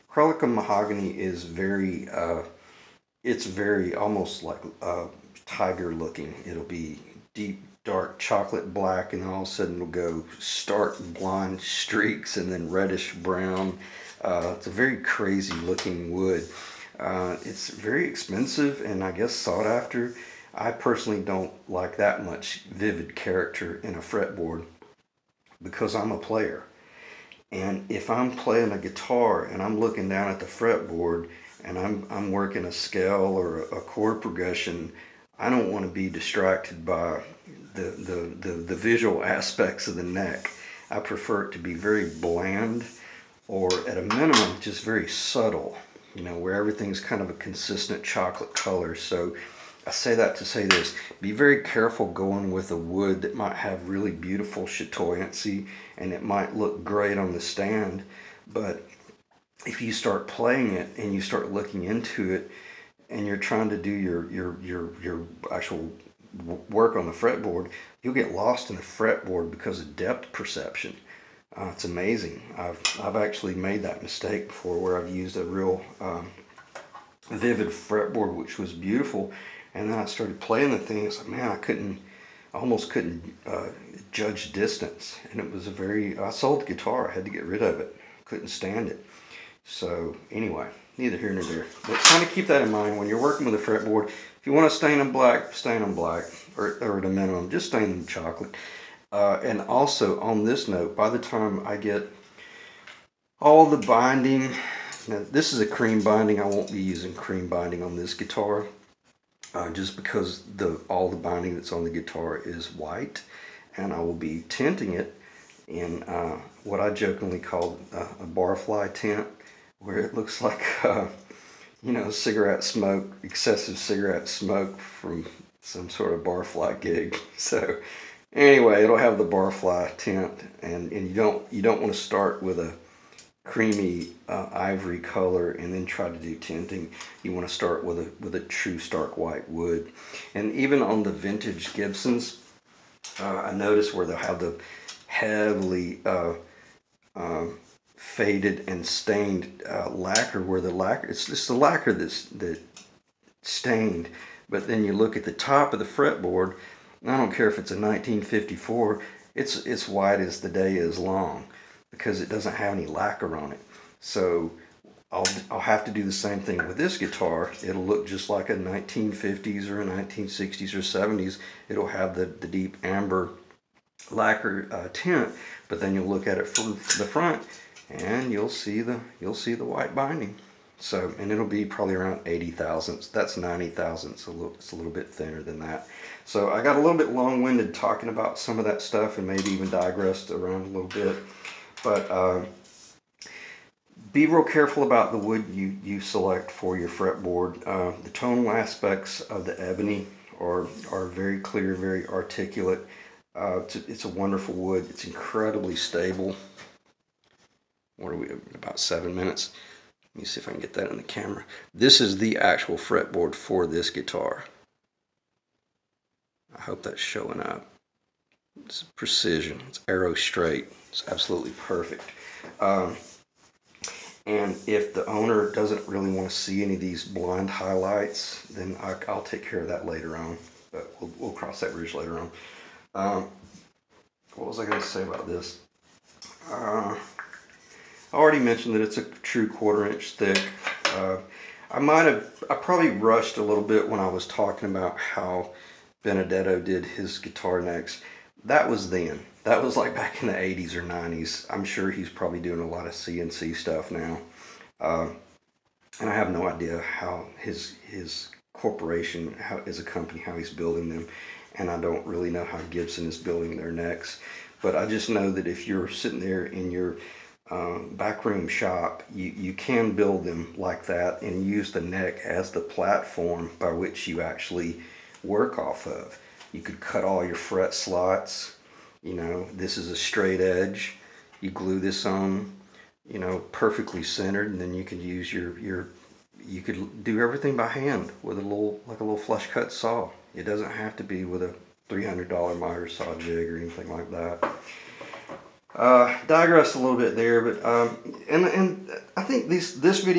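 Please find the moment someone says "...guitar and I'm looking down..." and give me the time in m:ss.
0:28.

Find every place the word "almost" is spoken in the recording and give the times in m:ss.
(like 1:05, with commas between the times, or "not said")
0:03, 1:22.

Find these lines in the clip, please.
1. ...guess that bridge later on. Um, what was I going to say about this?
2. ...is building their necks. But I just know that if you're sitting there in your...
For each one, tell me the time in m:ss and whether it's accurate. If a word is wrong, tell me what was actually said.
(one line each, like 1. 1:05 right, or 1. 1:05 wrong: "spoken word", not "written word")
1. 3:51 wrong: "cross", not "guess"
2. 4:23 right.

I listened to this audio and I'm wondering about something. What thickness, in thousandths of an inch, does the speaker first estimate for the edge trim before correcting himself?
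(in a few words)
80 thousandths.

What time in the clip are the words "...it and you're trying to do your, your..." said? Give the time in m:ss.
1:02.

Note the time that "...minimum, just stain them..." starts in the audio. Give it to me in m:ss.
1:37.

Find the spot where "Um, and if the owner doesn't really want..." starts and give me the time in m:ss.
3:42.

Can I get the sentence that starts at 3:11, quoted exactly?
But uh, be real careful about the wood you, you select for your fretboard.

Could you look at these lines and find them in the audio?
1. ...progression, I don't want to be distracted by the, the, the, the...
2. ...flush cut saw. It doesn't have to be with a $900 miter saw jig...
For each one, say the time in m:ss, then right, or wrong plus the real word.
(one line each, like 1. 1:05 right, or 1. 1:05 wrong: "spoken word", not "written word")
1. 0:34 right
2. 4:49 wrong: "300", not "900".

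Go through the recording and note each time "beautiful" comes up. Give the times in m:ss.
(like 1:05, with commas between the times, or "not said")
0:54, 1:18.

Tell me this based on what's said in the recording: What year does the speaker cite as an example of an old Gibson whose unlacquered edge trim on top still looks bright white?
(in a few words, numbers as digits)
1954.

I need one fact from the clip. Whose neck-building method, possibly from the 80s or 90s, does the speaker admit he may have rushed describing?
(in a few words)
Benedetto.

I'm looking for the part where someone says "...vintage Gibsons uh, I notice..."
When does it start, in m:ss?
2:21.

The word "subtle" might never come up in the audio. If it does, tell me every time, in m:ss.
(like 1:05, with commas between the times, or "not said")
0:45.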